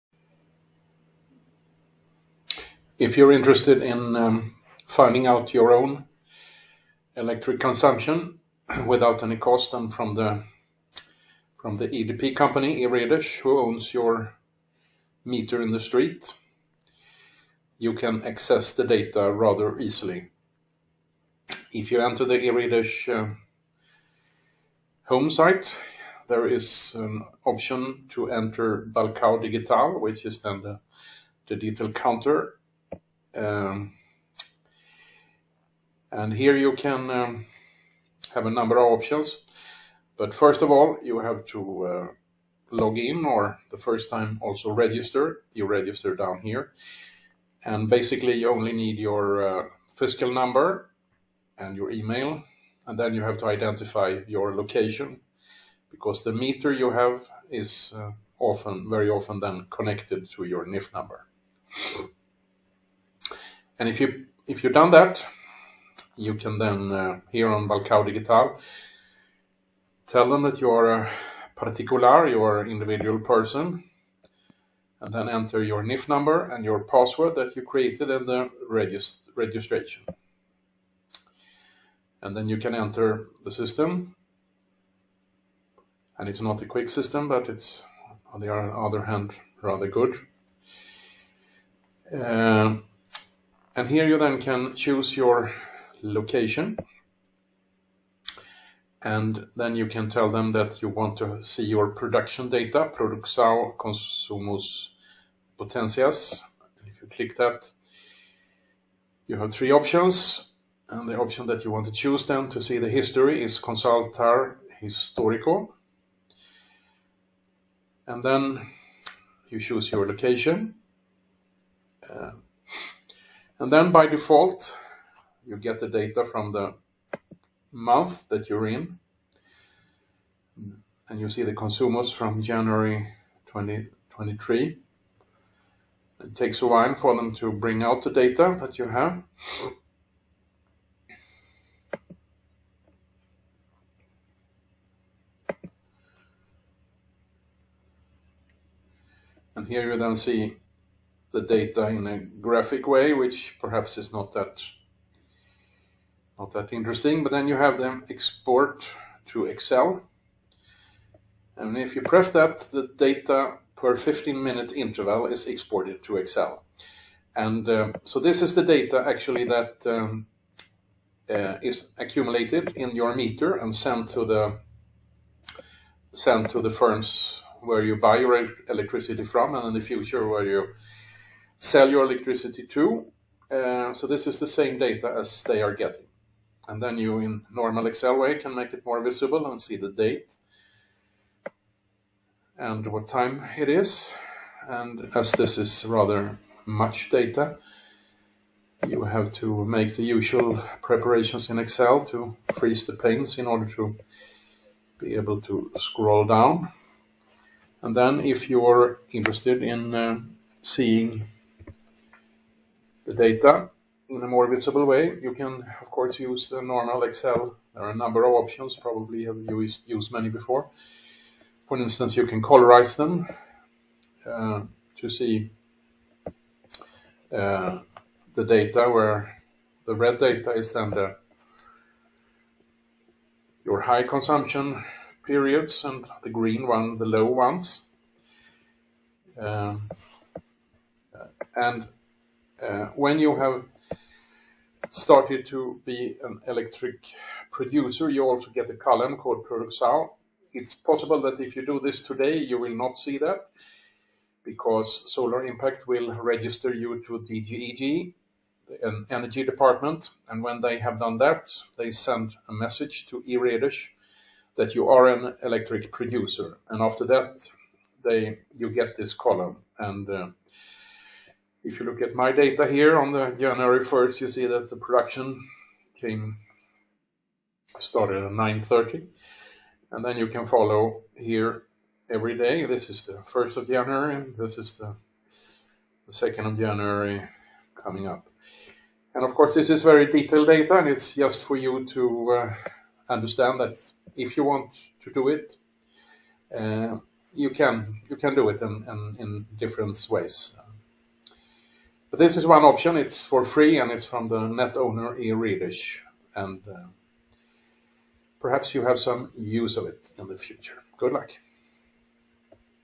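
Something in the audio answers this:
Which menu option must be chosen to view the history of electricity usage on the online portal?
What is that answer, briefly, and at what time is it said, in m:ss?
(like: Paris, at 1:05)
Consultar Historico, at 1:53.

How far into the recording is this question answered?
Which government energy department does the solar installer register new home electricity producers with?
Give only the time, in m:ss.
4:17.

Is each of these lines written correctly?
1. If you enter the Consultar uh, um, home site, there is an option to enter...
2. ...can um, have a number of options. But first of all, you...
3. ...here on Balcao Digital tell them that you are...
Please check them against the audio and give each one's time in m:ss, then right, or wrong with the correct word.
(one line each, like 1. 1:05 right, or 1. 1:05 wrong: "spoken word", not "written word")
1. 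0:21 wrong: "Eredish", not "Consultar"
2. 0:36 right
3. 1:07 right.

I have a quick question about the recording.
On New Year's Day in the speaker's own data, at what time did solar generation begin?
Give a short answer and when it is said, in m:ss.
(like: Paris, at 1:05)
9:30, at 4:38.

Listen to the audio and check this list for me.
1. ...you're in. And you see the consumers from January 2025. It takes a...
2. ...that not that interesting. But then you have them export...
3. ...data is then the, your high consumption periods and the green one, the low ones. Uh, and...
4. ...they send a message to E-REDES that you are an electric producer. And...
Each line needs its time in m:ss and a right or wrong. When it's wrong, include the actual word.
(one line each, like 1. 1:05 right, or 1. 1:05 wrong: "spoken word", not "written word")
1. 2:08 wrong: "2023", not "2025"
2. 2:34 right
3. 3:50 right
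4. 4:21 right.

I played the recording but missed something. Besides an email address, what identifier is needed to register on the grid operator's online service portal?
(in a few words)
Fiscal number.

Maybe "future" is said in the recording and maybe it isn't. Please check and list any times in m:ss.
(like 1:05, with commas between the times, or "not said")
2:59, 5:10.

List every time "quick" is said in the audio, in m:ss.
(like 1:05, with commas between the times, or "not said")
1:26.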